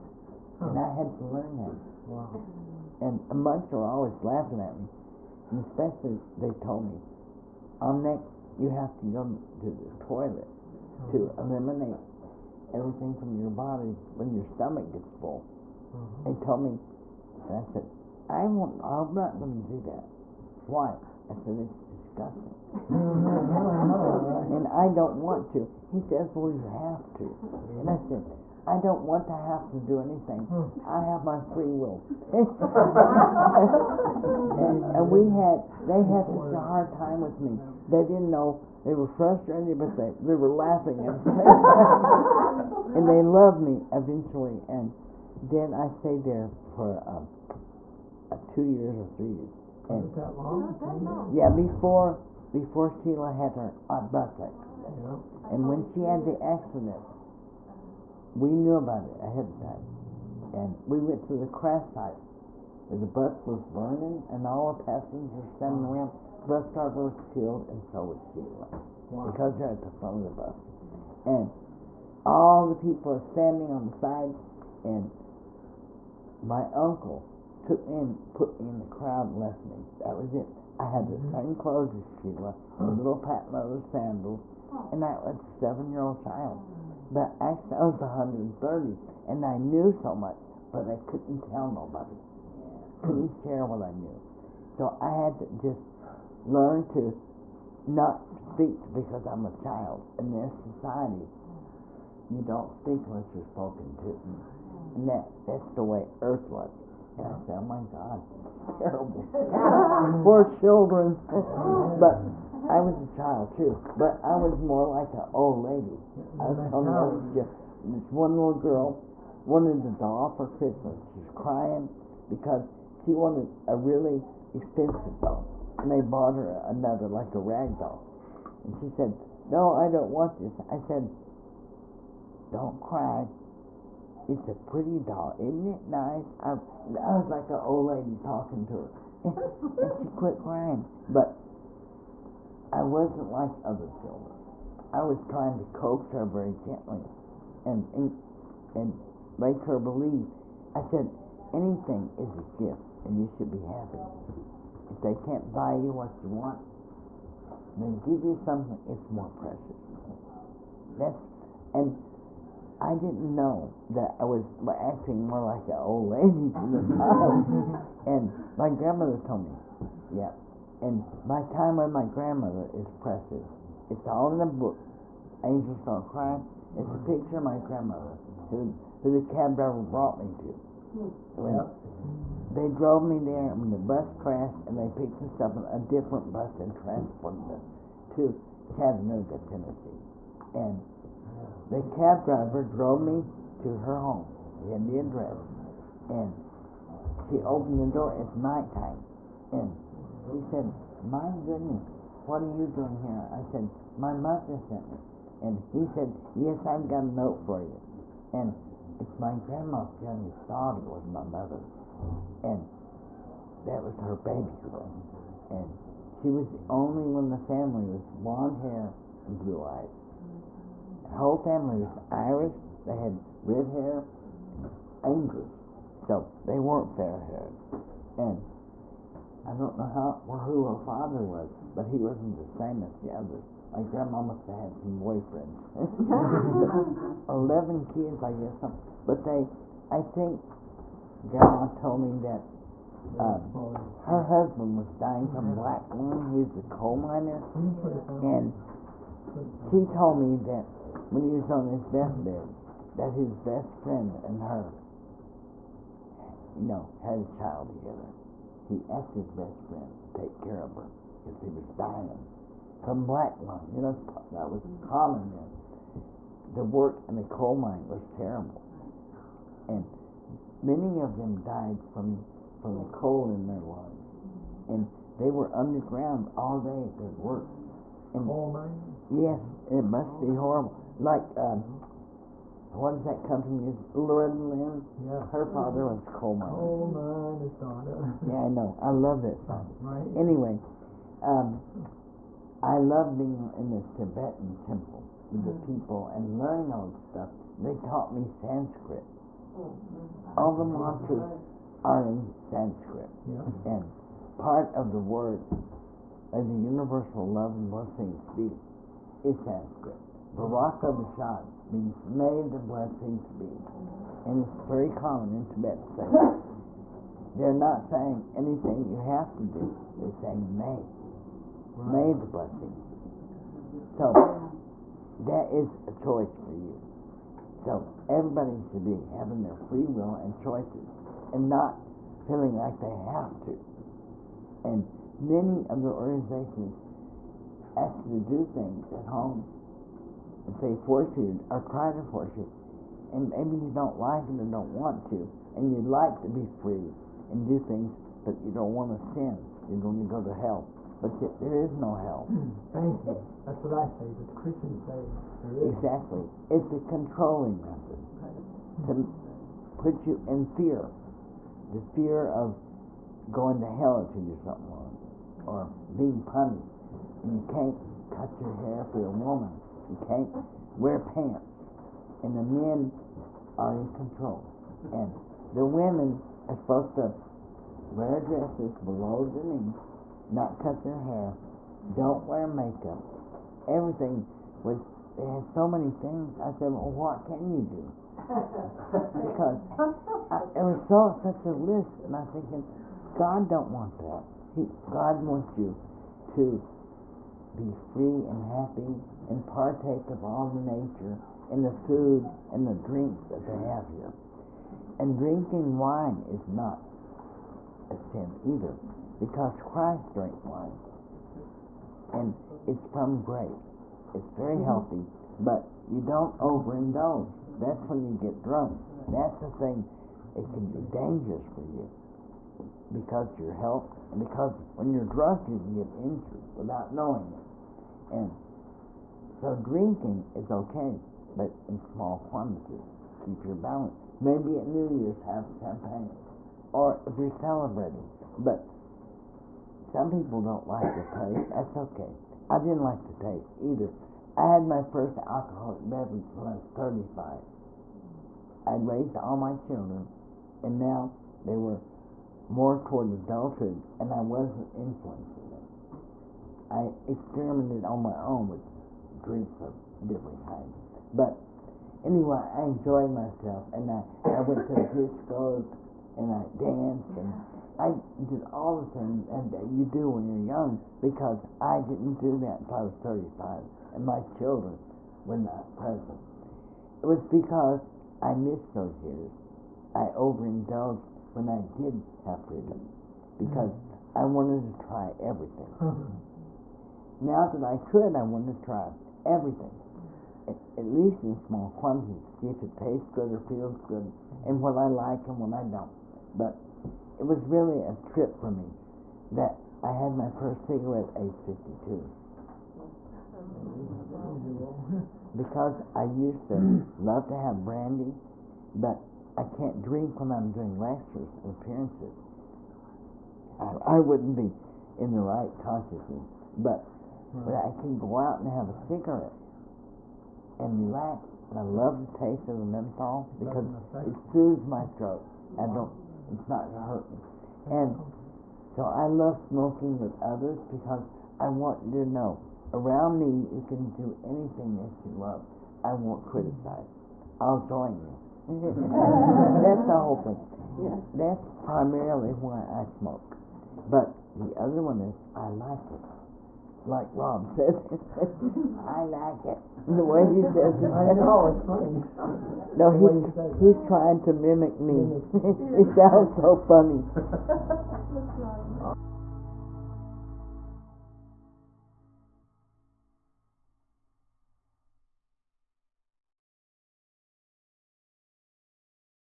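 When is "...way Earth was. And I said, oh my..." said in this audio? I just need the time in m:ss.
1:45.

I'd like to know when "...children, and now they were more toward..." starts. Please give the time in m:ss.
7:29.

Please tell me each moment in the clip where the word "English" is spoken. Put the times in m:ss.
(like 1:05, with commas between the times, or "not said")
3:45.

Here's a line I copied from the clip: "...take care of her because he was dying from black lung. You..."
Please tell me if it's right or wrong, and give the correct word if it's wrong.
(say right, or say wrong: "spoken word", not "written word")
right.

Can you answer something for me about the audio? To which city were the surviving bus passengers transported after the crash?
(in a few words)
Chattanooga, Tennessee.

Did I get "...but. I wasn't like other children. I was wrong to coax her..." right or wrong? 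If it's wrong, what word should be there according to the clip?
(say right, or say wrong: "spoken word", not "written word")
wrong: "trying", not "wrong".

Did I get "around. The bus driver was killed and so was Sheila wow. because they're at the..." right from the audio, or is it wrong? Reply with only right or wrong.
right.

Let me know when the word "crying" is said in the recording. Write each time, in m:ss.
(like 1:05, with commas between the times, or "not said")
2:01, 2:20.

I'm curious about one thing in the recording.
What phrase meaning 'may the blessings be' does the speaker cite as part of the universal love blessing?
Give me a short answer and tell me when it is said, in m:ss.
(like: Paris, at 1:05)
Baraka Bashad, at 5:10.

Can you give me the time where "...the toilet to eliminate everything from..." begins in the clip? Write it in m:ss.
0:09.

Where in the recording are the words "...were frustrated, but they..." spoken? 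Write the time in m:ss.
0:38.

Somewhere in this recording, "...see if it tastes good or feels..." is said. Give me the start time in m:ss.
8:12.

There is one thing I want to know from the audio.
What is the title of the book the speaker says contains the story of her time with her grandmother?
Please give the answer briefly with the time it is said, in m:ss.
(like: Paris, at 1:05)
Angels Don't Cry, at 2:55.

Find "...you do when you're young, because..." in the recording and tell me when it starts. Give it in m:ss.
7:49.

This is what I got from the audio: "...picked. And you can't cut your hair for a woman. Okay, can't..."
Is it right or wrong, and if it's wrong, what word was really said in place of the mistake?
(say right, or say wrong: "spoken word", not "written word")
wrong: "punished", not "picked".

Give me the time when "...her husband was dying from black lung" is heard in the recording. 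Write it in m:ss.
4:04.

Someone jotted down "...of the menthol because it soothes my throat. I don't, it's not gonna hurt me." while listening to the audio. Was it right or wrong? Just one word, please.
right.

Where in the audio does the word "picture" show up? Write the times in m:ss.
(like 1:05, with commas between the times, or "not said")
2:56.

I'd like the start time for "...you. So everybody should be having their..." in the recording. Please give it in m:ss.
5:26.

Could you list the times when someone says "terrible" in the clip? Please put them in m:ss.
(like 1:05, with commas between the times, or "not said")
1:48, 4:28.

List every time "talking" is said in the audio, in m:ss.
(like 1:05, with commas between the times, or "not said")
2:18.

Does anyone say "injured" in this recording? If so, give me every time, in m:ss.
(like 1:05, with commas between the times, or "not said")
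7:05.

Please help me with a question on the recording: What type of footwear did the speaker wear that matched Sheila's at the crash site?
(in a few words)
patent leather sandals.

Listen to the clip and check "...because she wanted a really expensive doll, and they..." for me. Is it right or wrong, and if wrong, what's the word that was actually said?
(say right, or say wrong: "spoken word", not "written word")
right.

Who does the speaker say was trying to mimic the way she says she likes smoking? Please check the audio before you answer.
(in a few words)
Rob.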